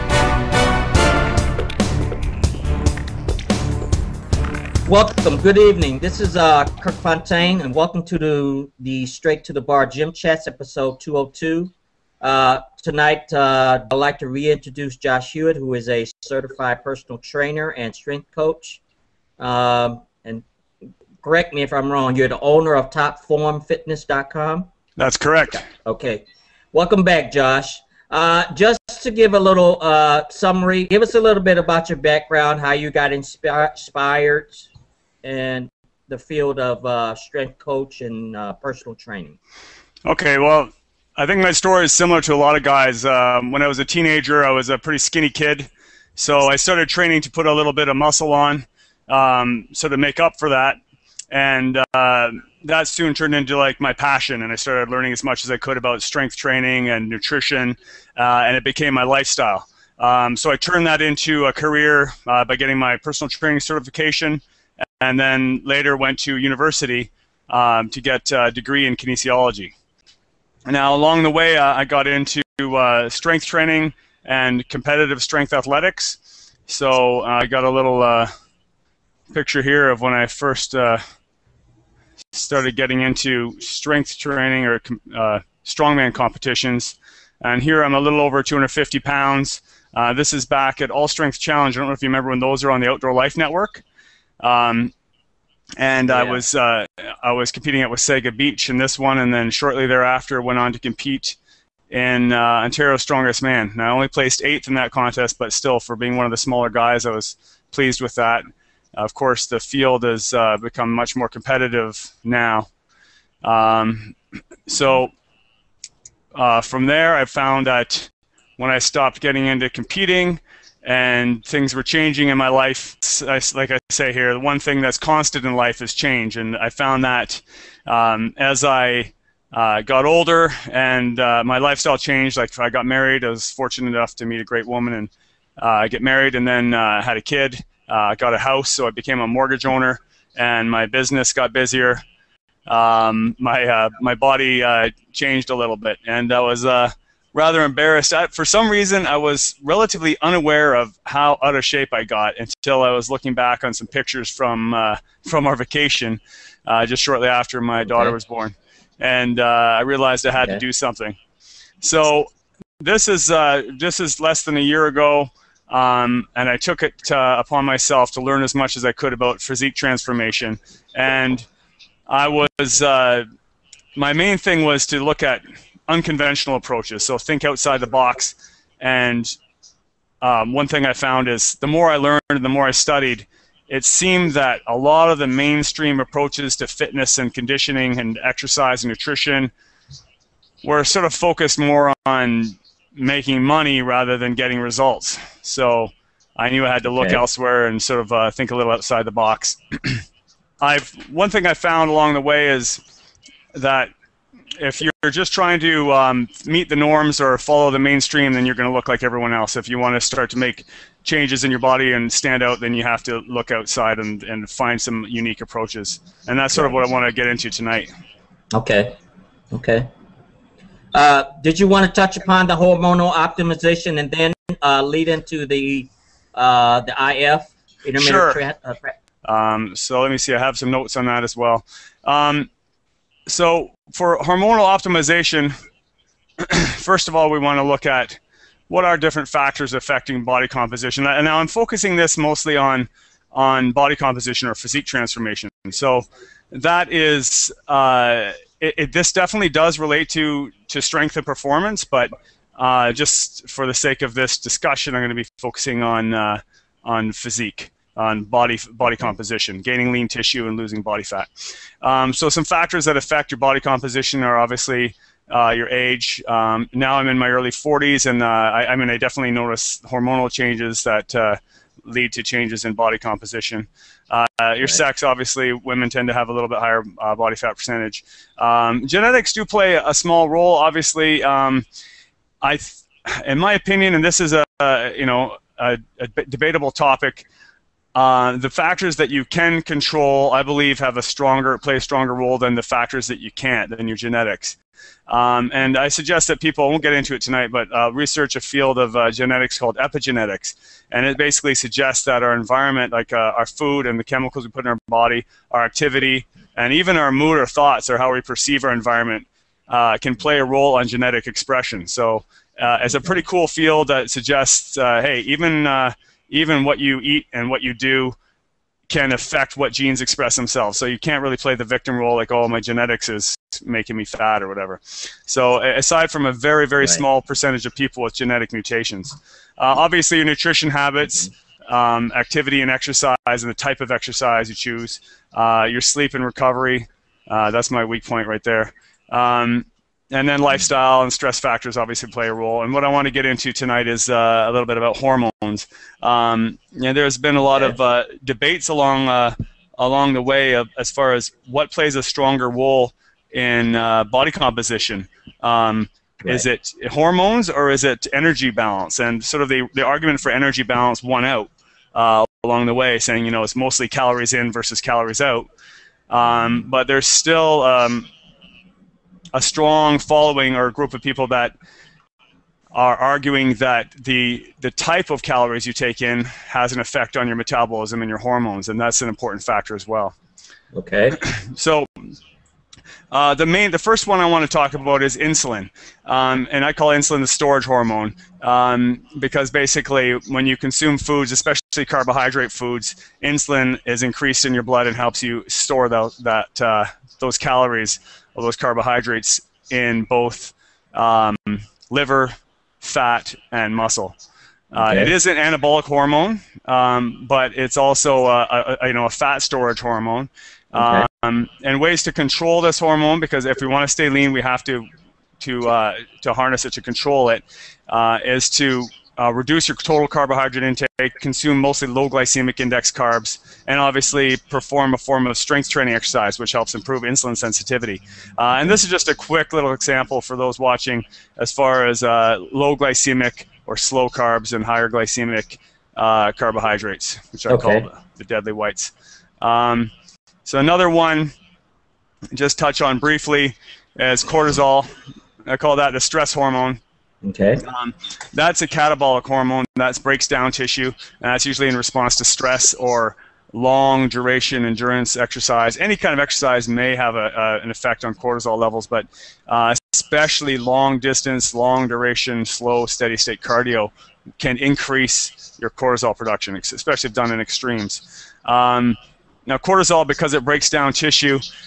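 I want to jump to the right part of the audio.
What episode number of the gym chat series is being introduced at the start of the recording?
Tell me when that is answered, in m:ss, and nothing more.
0:10.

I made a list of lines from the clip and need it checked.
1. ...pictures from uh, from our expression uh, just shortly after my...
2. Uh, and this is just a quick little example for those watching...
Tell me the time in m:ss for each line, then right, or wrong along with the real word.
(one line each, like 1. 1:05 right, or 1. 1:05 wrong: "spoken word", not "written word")
1. 2:33 wrong: "vacation", not "expression"
2. 7:08 right.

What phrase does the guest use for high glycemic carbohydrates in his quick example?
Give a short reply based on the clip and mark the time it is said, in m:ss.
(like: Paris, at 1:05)
the deadly whites, at 7:18.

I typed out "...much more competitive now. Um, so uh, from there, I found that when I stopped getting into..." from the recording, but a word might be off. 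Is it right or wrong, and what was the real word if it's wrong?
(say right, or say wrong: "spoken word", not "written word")
right.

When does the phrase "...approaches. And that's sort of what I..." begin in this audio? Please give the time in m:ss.
3:35.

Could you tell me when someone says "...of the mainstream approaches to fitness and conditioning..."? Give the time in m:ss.
3:05.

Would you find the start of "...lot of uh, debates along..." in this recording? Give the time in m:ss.
5:47.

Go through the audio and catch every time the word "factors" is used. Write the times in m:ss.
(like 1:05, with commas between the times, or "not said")
3:59, 4:22, 4:48, 4:52, 5:41, 6:19.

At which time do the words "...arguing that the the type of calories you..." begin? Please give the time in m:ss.
6:12.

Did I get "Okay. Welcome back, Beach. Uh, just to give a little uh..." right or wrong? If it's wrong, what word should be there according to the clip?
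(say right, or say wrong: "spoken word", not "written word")
wrong: "Josh", not "Beach".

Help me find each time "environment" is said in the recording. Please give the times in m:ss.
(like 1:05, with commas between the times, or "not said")
5:02, 5:08.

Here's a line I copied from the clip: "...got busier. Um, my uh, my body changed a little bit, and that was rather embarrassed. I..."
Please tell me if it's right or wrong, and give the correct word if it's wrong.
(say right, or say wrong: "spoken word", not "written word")
right.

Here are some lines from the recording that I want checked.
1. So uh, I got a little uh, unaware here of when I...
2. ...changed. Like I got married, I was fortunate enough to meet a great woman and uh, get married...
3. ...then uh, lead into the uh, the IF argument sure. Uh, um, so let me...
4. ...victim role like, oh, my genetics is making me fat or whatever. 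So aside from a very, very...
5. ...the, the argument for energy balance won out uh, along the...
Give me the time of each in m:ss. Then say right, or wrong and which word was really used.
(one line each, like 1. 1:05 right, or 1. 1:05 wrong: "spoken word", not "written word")
1. 1:16 wrong: "picture", not "unaware"
2. 2:11 right
3. 3:44 wrong: "intermittent", not "argument"
4. 5:21 right
5. 5:59 right.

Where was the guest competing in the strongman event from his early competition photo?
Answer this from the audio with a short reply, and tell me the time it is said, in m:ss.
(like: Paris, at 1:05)
Wasaga Beach, at 1:37.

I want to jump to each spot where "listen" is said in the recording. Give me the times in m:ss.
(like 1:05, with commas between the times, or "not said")
not said.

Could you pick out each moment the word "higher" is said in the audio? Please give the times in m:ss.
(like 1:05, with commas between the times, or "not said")
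4:36, 7:14.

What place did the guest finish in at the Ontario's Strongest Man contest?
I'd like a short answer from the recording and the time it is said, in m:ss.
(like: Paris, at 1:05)
eighth, at 1:44.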